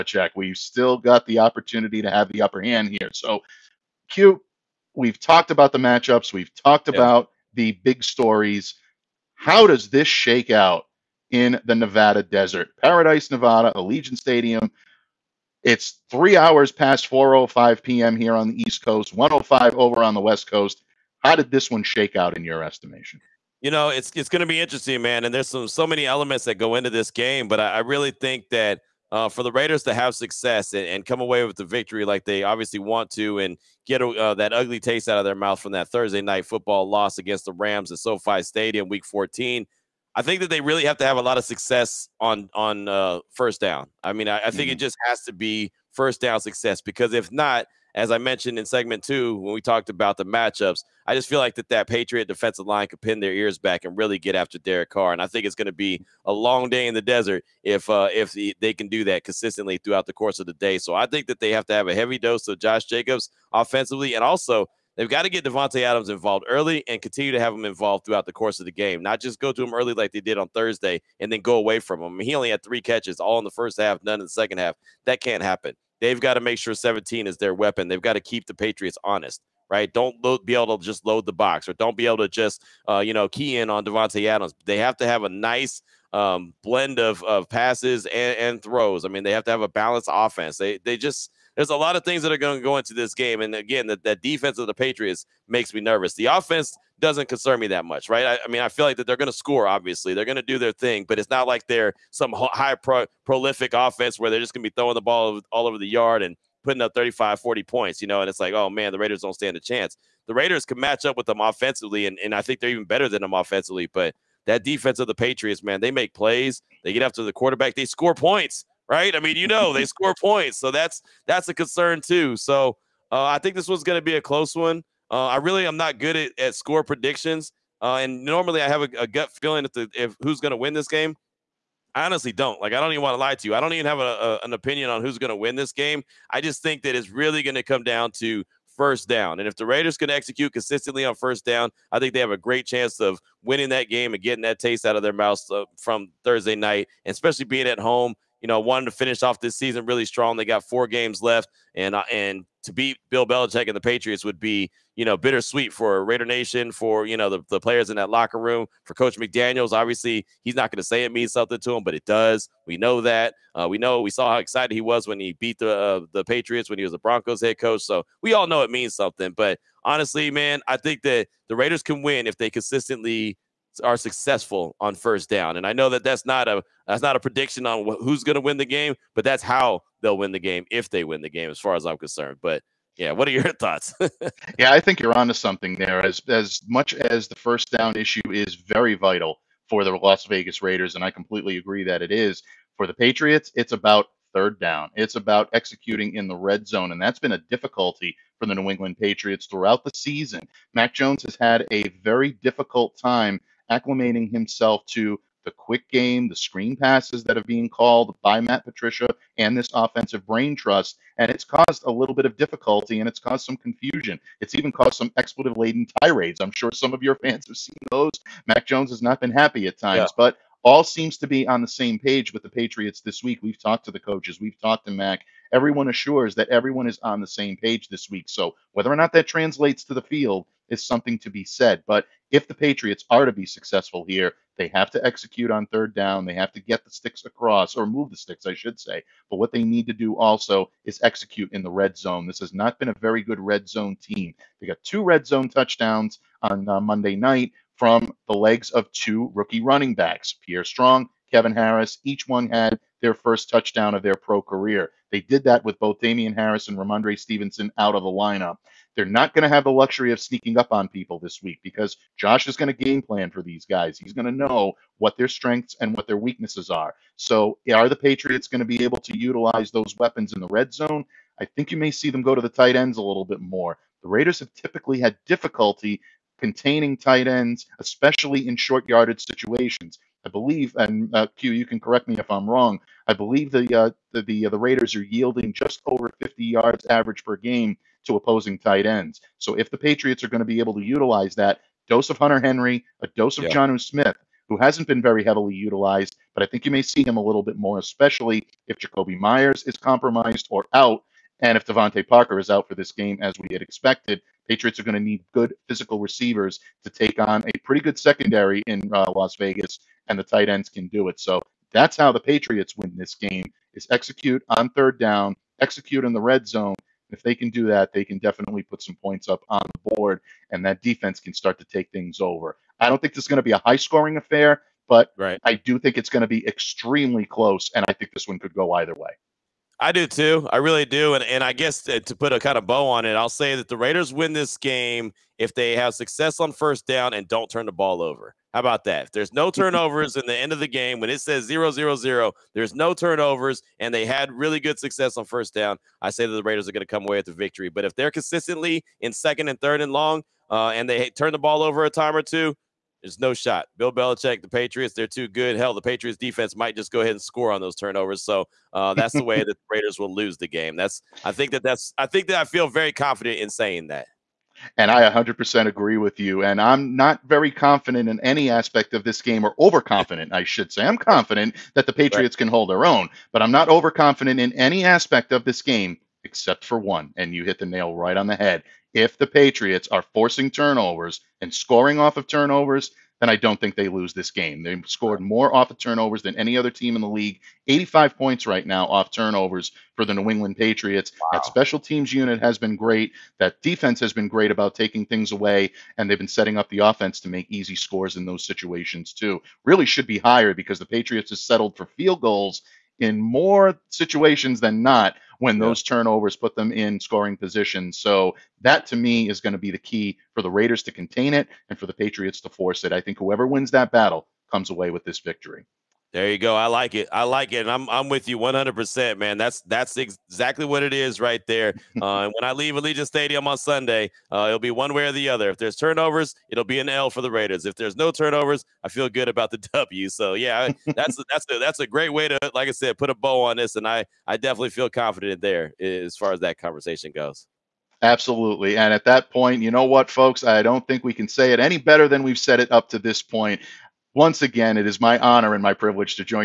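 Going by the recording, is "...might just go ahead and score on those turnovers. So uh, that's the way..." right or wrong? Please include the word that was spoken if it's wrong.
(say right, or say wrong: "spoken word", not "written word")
right.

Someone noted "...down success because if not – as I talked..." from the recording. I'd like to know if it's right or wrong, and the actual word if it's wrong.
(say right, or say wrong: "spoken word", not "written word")
wrong: "mentioned", not "talked".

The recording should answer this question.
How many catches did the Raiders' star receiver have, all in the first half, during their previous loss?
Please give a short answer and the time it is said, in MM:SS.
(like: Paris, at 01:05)
3, at 01:12.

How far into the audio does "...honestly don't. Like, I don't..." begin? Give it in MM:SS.
02:12.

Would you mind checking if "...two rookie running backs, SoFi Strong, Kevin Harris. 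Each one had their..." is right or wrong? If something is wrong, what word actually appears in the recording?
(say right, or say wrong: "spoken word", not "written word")
wrong: "Pierre", not "SoFi".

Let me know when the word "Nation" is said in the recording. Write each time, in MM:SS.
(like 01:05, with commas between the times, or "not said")
02:36.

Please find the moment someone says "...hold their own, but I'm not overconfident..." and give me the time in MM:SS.
06:12.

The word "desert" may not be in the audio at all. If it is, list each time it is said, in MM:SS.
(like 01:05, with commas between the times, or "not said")
00:12, 00:57.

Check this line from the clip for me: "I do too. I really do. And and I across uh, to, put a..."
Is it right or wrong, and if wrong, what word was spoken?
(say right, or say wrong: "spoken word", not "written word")
wrong: "guess", not "across".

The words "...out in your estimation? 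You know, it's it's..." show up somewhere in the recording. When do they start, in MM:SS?
00:22.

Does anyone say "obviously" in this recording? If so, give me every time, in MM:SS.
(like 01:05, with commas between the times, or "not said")
00:32, 01:39, 02:39.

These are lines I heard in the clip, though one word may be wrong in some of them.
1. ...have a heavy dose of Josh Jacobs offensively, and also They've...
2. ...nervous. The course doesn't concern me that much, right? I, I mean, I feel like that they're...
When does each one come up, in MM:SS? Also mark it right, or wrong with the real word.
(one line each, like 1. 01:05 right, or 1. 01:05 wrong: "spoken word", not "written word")
1. 01:01 right
2. 01:35 wrong: "offense", not "course".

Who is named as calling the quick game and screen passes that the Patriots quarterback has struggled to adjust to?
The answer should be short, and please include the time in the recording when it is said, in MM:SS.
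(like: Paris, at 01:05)
Matt Patricia, at 03:28.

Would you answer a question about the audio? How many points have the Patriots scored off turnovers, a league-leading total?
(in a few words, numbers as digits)
85.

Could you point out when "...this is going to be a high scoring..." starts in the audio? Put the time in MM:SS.
05:23.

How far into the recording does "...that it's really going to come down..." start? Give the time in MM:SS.
02:16.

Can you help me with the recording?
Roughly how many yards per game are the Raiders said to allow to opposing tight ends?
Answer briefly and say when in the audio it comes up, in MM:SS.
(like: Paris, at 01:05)
Just over 50, at 04:45.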